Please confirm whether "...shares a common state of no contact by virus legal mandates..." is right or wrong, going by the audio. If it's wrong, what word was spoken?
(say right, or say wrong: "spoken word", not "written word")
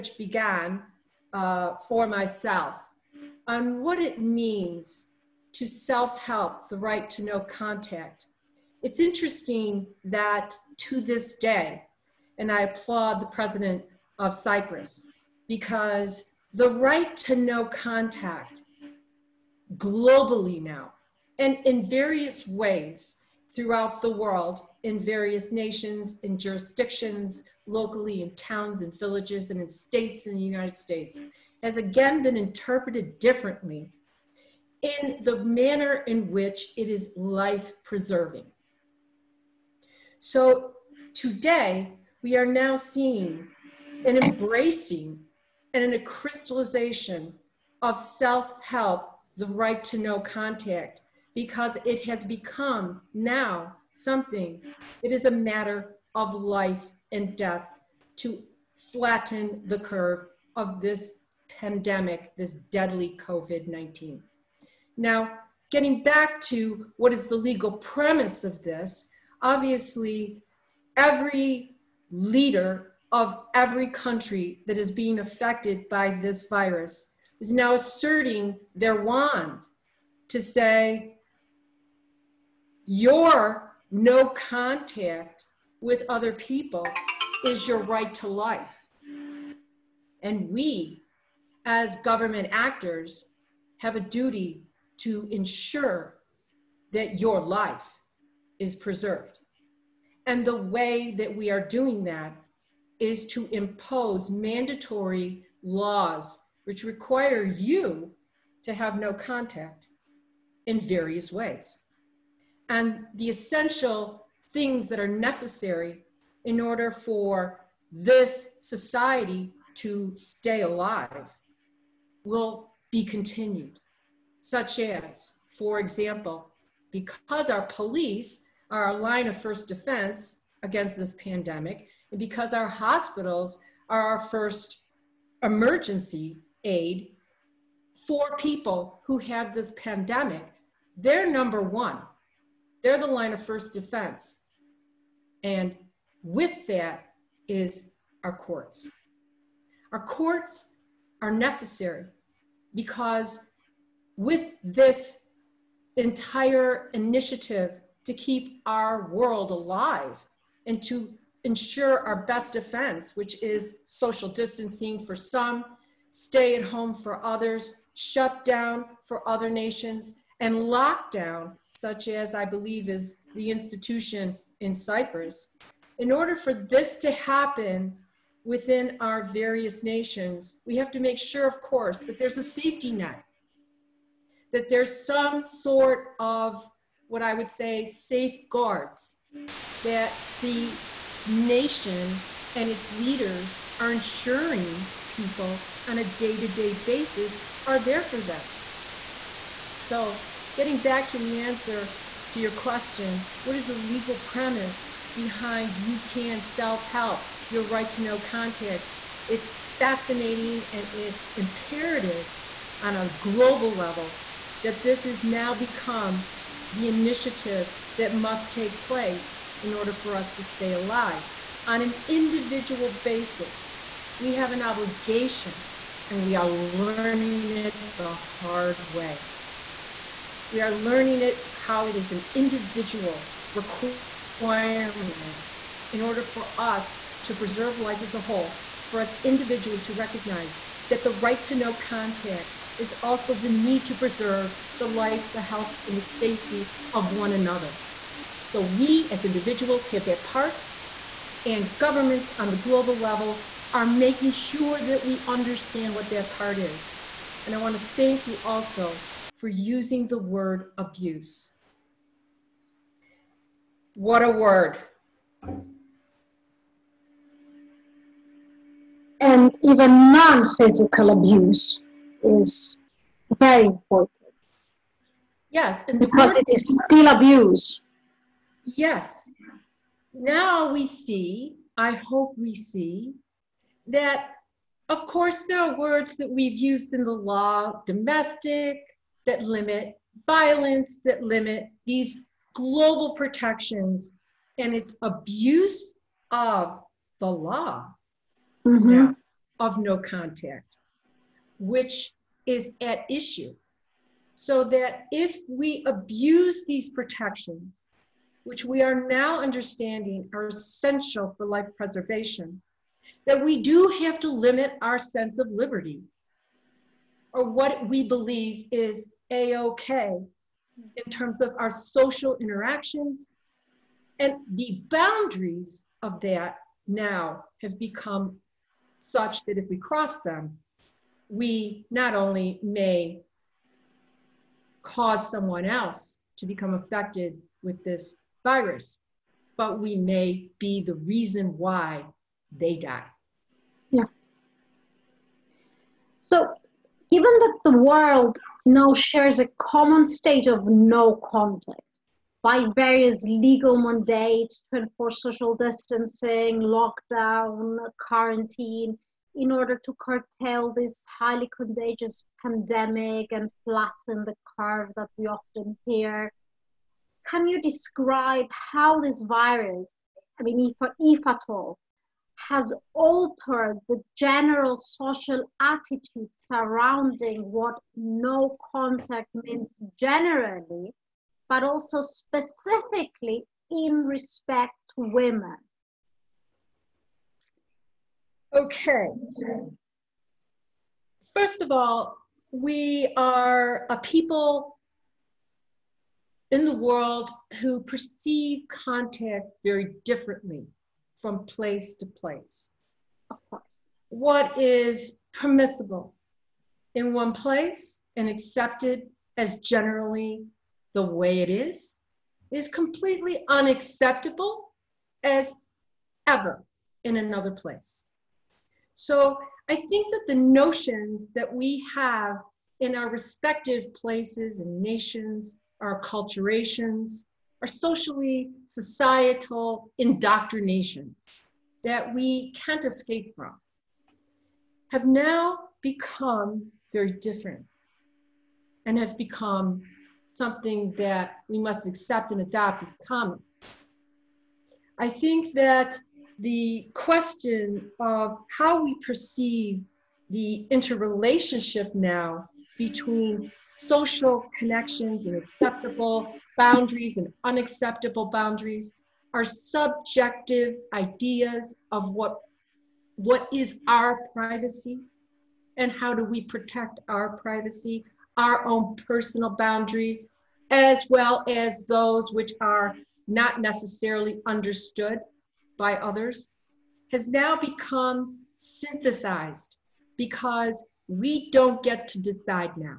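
wrong: "various", not "virus".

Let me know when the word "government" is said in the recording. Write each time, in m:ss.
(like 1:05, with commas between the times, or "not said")
1:31, 4:11.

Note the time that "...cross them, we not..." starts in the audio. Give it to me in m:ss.
5:29.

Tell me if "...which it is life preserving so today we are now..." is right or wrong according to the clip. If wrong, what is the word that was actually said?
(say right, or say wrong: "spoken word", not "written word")
right.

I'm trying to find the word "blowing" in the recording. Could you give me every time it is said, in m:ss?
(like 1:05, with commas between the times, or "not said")
not said.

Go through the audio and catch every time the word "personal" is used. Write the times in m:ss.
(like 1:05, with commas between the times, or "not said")
7:49.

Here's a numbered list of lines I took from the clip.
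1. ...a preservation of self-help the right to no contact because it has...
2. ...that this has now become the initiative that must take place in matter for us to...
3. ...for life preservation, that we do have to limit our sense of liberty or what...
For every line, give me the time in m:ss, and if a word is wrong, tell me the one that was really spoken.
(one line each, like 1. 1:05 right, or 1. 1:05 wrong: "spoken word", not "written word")
1. 0:45 wrong: "crystallization", not "preservation"
2. 3:34 wrong: "order", not "matter"
3. 5:11 right.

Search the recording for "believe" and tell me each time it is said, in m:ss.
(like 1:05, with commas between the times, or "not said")
2:52, 5:18.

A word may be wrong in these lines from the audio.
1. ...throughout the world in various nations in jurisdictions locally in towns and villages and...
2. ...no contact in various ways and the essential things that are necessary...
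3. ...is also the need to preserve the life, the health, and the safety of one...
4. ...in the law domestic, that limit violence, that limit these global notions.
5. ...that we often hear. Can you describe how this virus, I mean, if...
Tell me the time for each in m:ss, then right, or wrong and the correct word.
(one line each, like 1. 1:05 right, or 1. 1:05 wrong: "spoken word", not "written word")
1. 0:23 right
2. 1:48 right
3. 4:02 right
4. 4:46 wrong: "protections", not "notions"
5. 6:04 right.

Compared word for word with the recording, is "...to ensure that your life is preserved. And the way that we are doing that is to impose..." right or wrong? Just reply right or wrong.
right.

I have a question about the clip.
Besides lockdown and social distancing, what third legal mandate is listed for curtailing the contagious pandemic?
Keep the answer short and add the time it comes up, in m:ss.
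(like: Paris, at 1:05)
Quarantine, at 5:58.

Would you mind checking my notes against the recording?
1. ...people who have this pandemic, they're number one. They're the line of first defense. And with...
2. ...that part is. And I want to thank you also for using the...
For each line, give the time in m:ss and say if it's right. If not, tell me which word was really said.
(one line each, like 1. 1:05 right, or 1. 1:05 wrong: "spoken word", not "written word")
1. 2:18 right
2. 4:16 right.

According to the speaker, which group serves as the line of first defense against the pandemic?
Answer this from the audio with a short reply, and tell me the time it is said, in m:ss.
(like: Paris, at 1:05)
Police, at 2:07.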